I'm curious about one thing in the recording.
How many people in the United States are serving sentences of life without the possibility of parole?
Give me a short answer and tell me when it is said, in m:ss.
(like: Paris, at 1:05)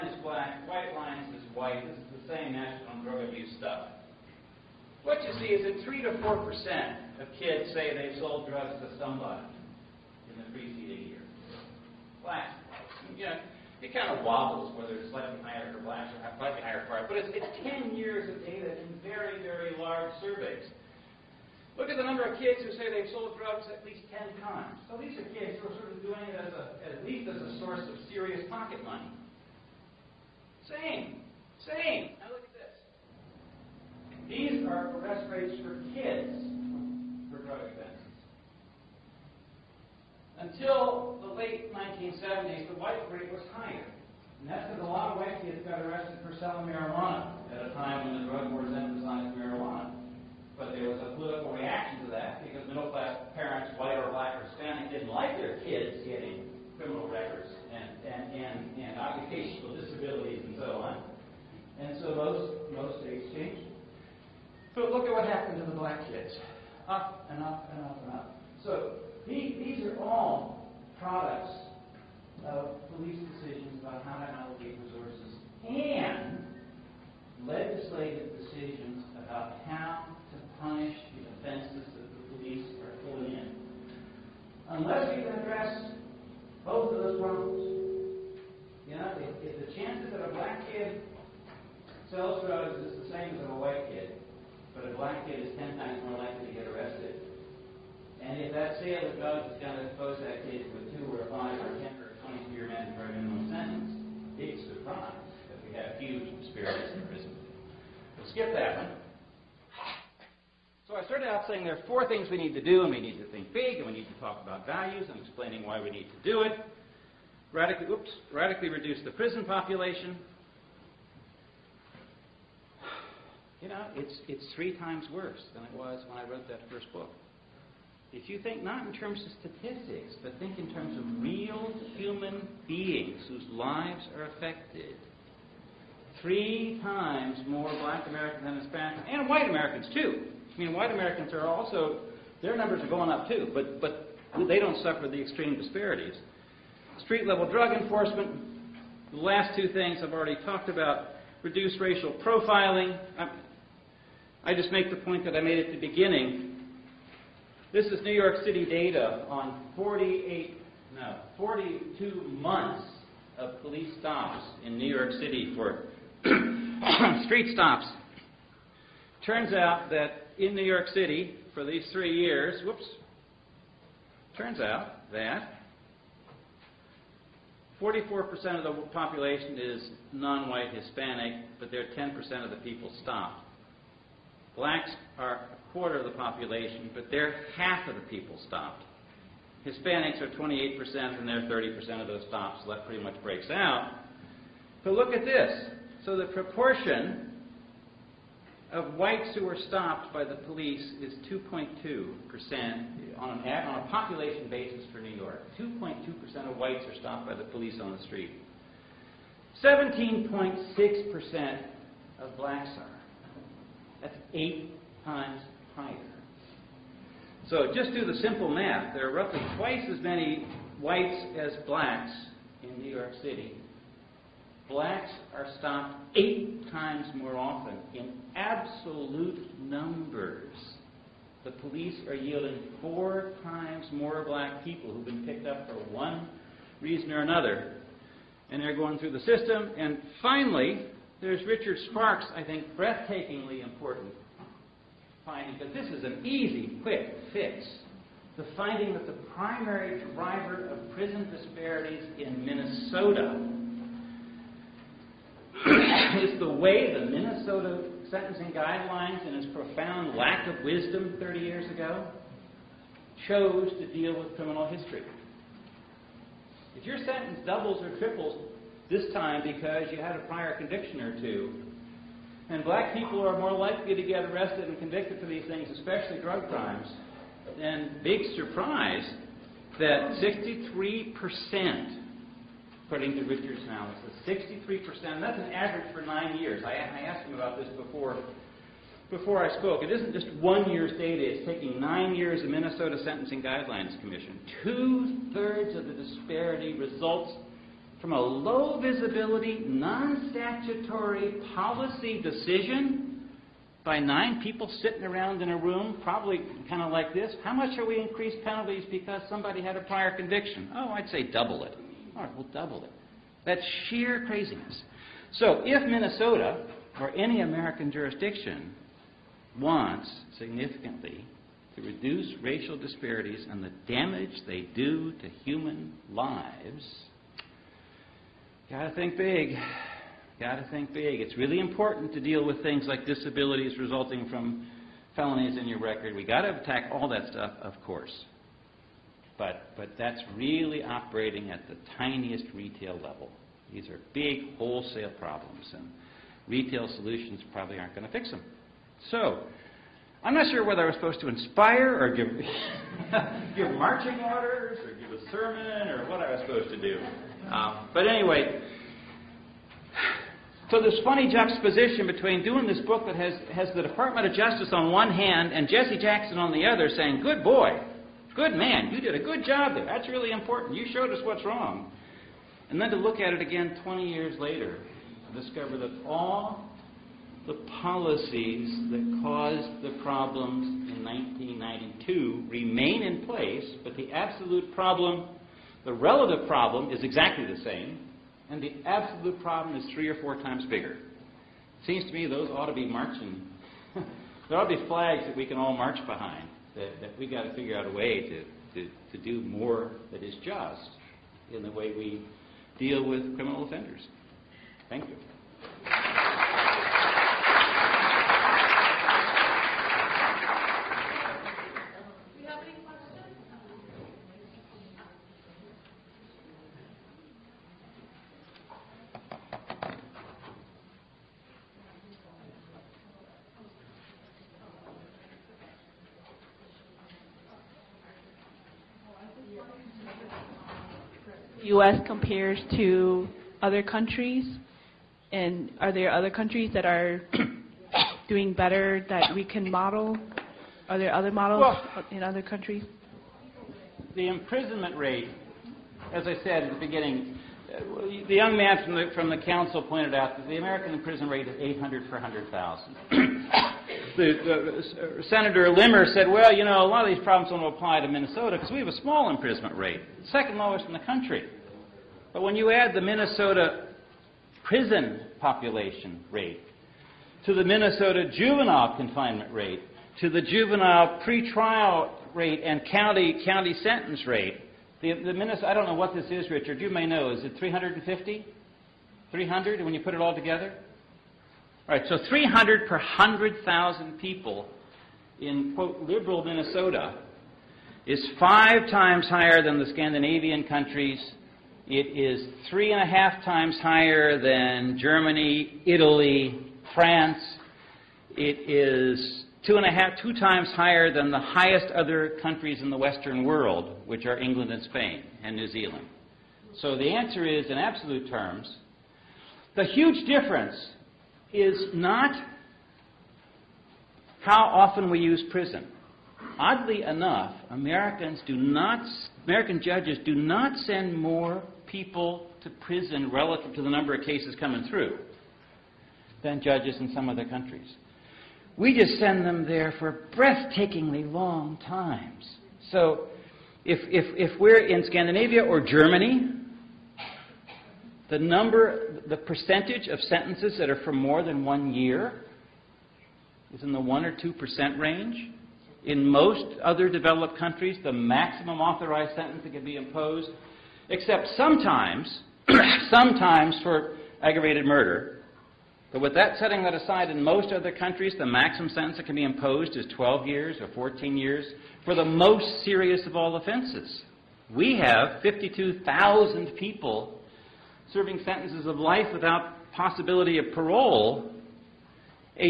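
52,000, at 9:25.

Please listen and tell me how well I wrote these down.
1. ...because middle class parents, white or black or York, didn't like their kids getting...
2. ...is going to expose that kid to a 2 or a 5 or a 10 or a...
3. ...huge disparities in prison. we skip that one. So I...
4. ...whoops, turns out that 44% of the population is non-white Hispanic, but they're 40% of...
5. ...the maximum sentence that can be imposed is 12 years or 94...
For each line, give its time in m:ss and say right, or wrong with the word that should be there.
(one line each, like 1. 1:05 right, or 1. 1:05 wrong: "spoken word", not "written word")
1. 0:52 wrong: "Hispanic", not "York"
2. 1:39 right
3. 1:45 right
4. 2:52 wrong: "10", not "40"
5. 9:18 wrong: "14", not "94".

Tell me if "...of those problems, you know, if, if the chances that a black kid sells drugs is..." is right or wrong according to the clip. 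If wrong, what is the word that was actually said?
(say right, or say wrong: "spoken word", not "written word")
right.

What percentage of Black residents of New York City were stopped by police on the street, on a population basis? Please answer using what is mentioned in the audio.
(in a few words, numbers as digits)
17.6%.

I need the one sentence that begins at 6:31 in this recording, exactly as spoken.
Seems to me those ought to be marching.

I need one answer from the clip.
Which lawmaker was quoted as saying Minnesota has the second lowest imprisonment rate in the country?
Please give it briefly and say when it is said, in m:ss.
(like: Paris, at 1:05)
Senator Limmer, at 7:35.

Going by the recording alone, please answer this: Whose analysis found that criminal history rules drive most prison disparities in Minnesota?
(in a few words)
Richard Sparks.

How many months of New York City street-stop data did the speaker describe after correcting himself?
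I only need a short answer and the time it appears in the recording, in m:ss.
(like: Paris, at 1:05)
42, at 2:41.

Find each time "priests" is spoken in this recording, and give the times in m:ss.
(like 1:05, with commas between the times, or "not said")
not said.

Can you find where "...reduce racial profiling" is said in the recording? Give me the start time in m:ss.
2:31.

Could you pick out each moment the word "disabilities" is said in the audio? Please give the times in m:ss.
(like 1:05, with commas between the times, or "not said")
0:59, 5:33.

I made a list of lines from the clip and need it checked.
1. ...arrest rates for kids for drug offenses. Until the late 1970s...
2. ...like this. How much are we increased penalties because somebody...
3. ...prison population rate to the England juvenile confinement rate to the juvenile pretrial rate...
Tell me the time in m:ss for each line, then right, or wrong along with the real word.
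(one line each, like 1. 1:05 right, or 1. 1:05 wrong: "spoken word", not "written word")
1. 0:34 right
2. 5:06 right
3. 7:44 wrong: "Minnesota", not "England".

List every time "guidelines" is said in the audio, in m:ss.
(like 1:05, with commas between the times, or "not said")
4:18, 4:53.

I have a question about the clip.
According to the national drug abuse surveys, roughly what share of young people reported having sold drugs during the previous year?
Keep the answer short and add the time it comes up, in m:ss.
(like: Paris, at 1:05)
3 to 4%, at 0:05.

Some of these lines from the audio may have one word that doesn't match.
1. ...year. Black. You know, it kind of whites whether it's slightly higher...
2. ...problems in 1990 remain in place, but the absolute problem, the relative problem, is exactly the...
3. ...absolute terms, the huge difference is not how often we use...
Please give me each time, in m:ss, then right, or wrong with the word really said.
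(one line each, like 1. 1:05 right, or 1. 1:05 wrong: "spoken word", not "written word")
1. 0:11 wrong: "wobbles", not "whites"
2. 6:20 wrong: "1992", not "1990"
3. 8:27 right.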